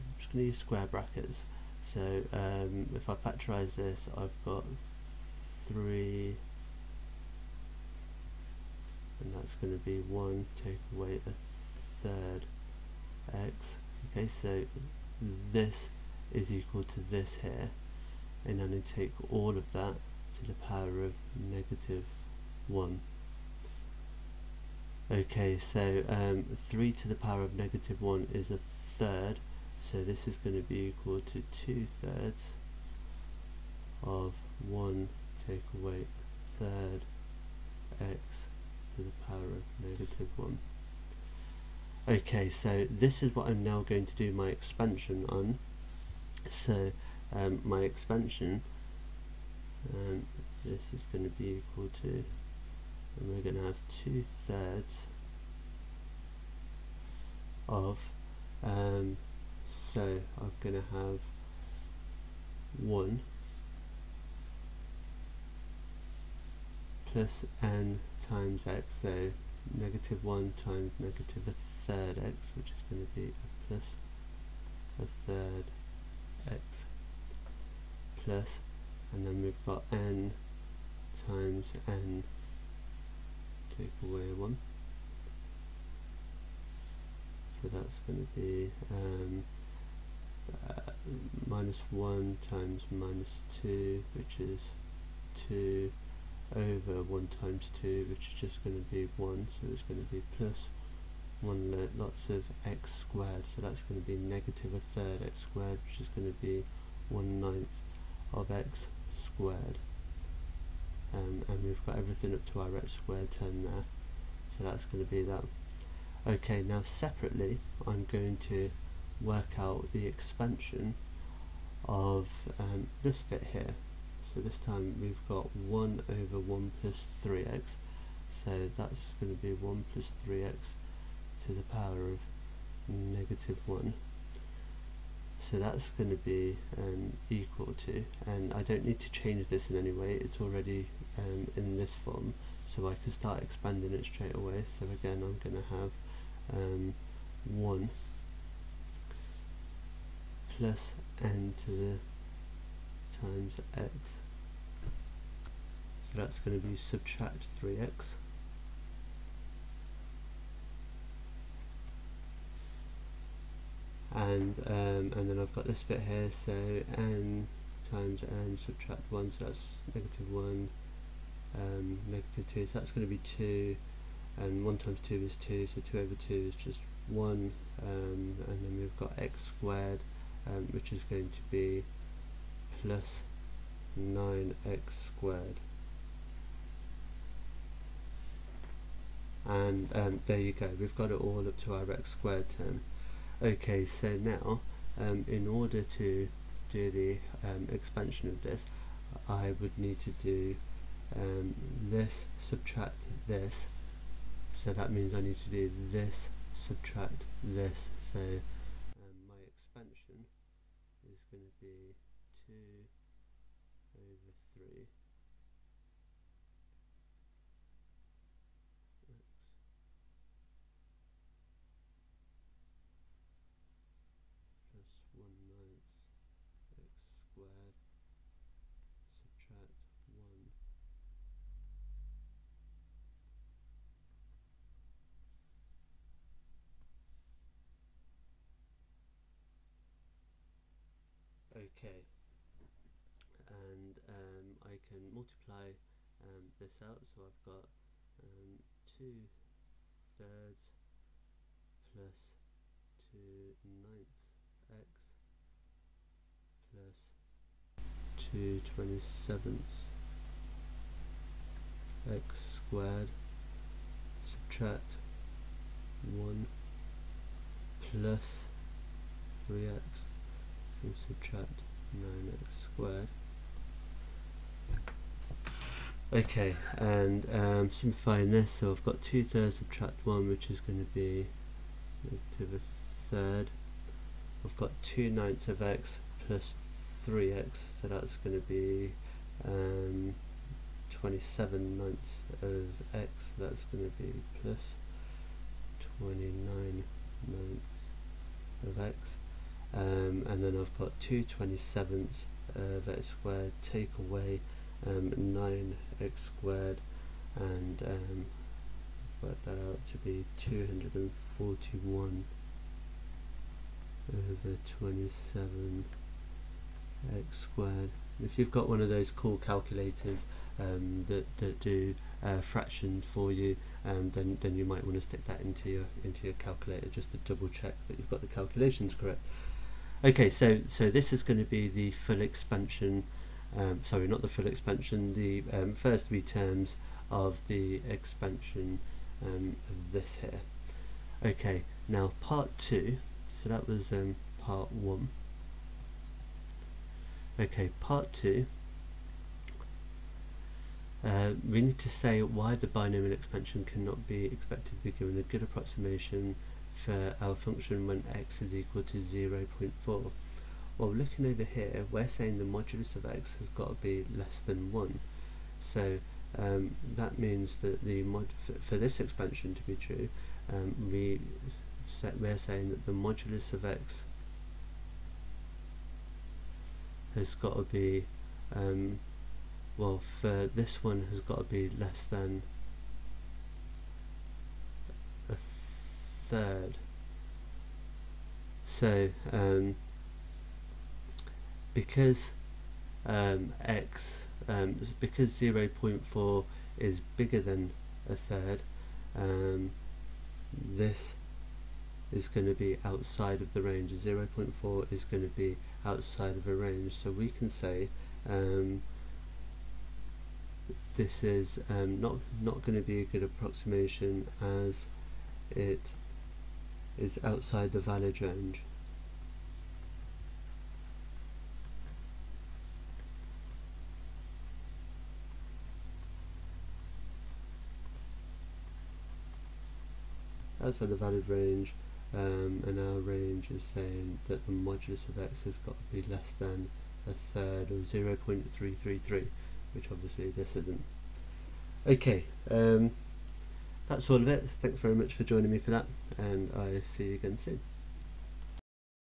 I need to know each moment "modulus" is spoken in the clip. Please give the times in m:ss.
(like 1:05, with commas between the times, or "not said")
6:02, 6:12, 7:14.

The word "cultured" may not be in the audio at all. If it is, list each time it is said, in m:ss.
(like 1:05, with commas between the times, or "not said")
not said.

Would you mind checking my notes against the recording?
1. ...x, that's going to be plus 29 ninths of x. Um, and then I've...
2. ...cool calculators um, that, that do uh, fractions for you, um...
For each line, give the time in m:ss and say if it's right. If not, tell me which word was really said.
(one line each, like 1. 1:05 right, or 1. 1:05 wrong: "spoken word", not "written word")
1. 4:52 right
2. 5:19 right.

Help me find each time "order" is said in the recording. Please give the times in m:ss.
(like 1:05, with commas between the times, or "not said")
3:15.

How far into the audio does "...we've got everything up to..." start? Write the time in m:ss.
1:51.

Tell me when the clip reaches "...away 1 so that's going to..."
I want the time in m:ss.
1:24.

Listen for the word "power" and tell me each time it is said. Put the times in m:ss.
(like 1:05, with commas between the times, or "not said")
0:20, 0:27, 0:39, 2:11.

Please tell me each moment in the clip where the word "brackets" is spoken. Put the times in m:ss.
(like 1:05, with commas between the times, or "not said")
0:00.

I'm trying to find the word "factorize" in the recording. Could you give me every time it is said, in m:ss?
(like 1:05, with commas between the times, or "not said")
0:03.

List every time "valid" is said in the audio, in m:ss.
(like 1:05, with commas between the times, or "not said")
6:57, 7:10.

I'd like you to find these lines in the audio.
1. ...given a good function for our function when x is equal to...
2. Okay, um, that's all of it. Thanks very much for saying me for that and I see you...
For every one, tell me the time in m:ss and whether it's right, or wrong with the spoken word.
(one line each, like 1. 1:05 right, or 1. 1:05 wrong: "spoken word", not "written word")
1. 5:54 wrong: "approximation", not "function"
2. 7:21 wrong: "joining", not "saying".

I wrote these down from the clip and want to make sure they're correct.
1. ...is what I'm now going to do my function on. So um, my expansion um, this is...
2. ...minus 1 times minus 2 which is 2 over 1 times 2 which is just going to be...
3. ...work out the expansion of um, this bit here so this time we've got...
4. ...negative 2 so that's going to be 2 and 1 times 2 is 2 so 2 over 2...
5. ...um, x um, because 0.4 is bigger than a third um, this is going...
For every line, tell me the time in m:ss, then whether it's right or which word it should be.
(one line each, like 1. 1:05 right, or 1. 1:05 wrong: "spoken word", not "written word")
1. 0:43 wrong: "expansion", not "function"
2. 1:31 right
3. 1:59 right
4. 2:52 right
5. 6:33 right.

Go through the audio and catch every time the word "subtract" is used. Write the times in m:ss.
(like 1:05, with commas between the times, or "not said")
2:36, 2:48, 3:22, 3:26, 3:49, 4:24, 4:31, 4:39.